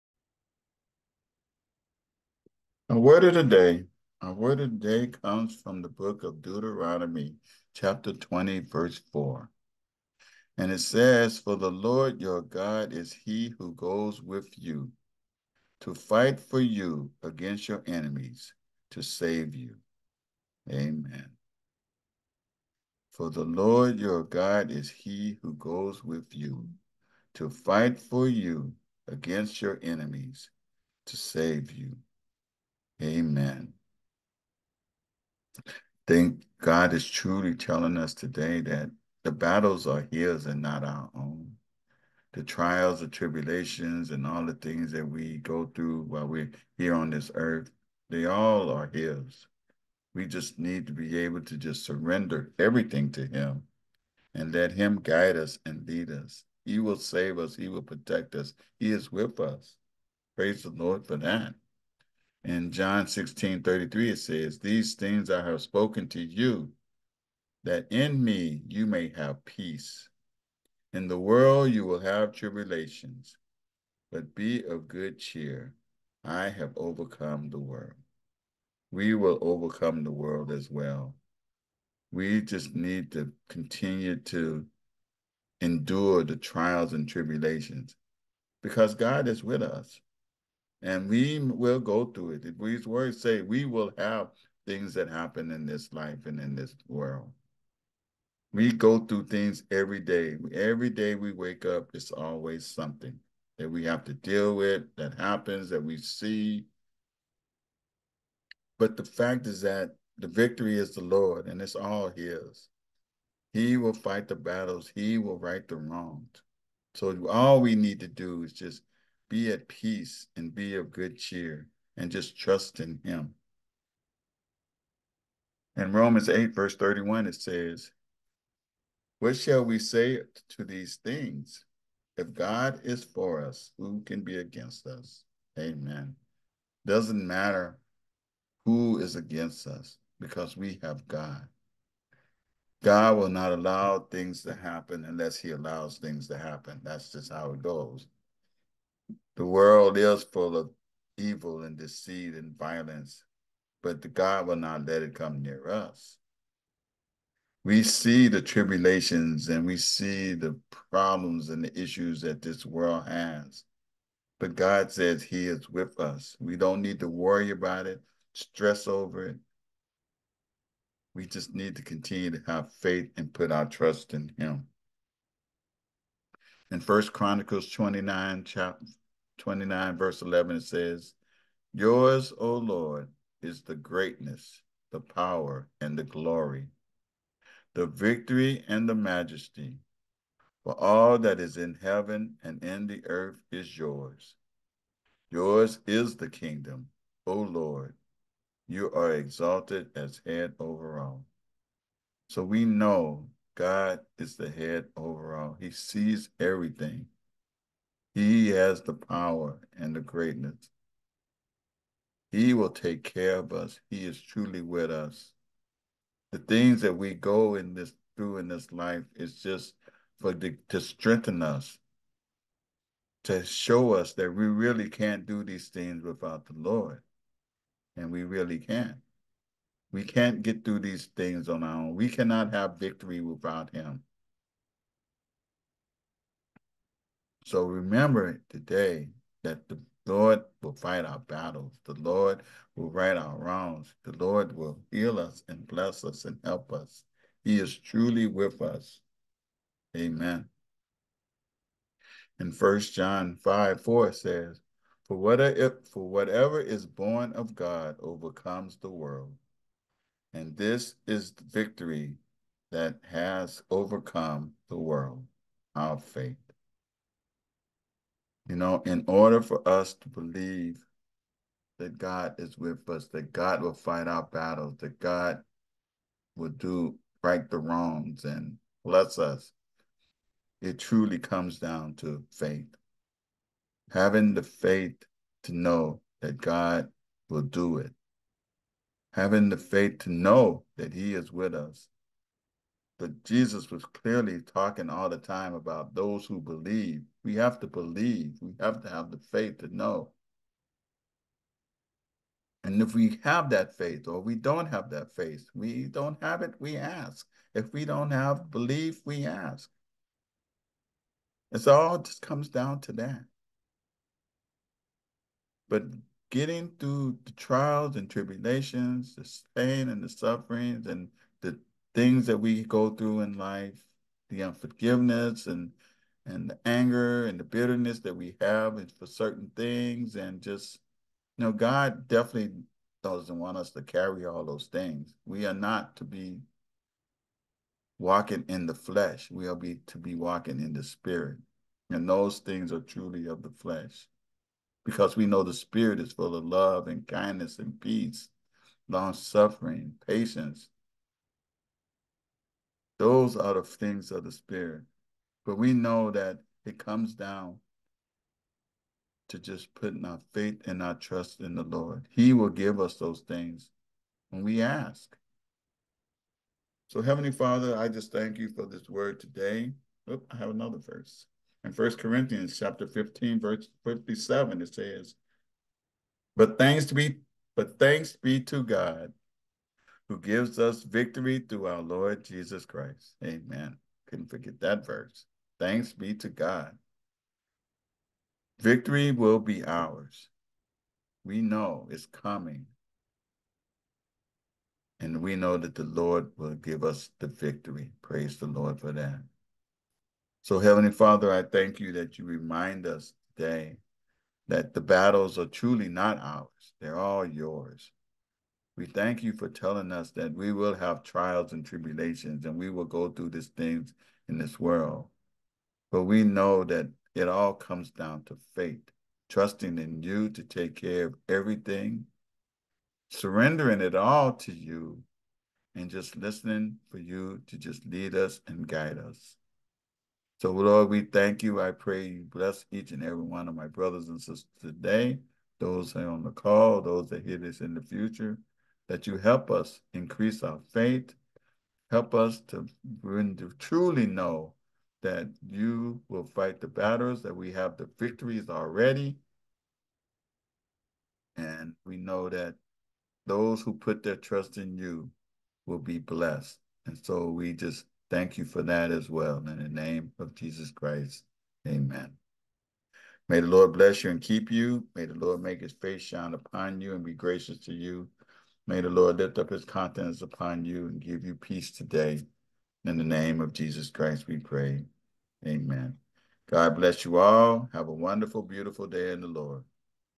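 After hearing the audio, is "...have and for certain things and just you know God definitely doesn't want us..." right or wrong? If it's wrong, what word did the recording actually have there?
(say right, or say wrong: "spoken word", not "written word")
right.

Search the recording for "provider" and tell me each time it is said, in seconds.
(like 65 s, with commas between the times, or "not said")
not said.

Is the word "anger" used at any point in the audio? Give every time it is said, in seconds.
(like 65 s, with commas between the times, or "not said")
326 s.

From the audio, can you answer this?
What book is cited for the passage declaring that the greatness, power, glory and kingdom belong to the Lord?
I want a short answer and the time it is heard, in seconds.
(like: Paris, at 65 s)
First Chronicles, at 176 s.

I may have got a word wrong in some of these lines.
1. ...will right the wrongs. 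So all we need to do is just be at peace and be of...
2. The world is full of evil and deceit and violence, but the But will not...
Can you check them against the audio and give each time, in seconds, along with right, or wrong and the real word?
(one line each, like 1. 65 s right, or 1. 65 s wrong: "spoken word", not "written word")
1. 115 s right
2. 149 s wrong: "God", not "But".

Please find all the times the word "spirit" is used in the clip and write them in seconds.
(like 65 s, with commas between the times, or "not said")
340 s, 345 s, 354 s.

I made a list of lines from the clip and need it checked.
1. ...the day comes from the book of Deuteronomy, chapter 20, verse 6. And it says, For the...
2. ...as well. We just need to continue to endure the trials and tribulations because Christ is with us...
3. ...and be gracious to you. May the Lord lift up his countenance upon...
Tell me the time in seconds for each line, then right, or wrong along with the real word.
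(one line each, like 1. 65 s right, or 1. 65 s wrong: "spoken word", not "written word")
1. 4 s wrong: "4", not "6"
2. 80 s wrong: "God", not "Christ"
3. 466 s right.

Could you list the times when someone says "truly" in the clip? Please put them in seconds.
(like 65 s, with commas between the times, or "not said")
37 s, 214 s, 247 s, 280 s, 342 s, 405 s, 443 s.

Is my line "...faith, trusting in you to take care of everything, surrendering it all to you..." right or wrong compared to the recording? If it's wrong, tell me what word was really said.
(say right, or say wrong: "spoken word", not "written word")
right.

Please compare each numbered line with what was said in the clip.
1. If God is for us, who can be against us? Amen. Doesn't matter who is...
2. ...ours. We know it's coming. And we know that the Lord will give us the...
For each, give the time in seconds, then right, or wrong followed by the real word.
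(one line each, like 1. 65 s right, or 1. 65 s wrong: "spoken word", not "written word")
1. 132 s right
2. 389 s right.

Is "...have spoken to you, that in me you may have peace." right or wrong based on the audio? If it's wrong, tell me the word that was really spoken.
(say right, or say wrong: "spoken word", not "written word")
right.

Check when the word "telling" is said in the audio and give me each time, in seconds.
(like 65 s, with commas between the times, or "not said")
37 s, 409 s.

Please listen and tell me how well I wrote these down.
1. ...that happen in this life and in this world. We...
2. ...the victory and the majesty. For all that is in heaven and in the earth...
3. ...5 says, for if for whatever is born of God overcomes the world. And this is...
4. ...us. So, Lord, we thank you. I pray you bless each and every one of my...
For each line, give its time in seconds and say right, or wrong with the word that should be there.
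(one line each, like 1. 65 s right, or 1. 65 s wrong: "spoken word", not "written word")
1. 94 s right
2. 187 s right
3. 253 s wrong: "4", not "5"
4. 428 s right.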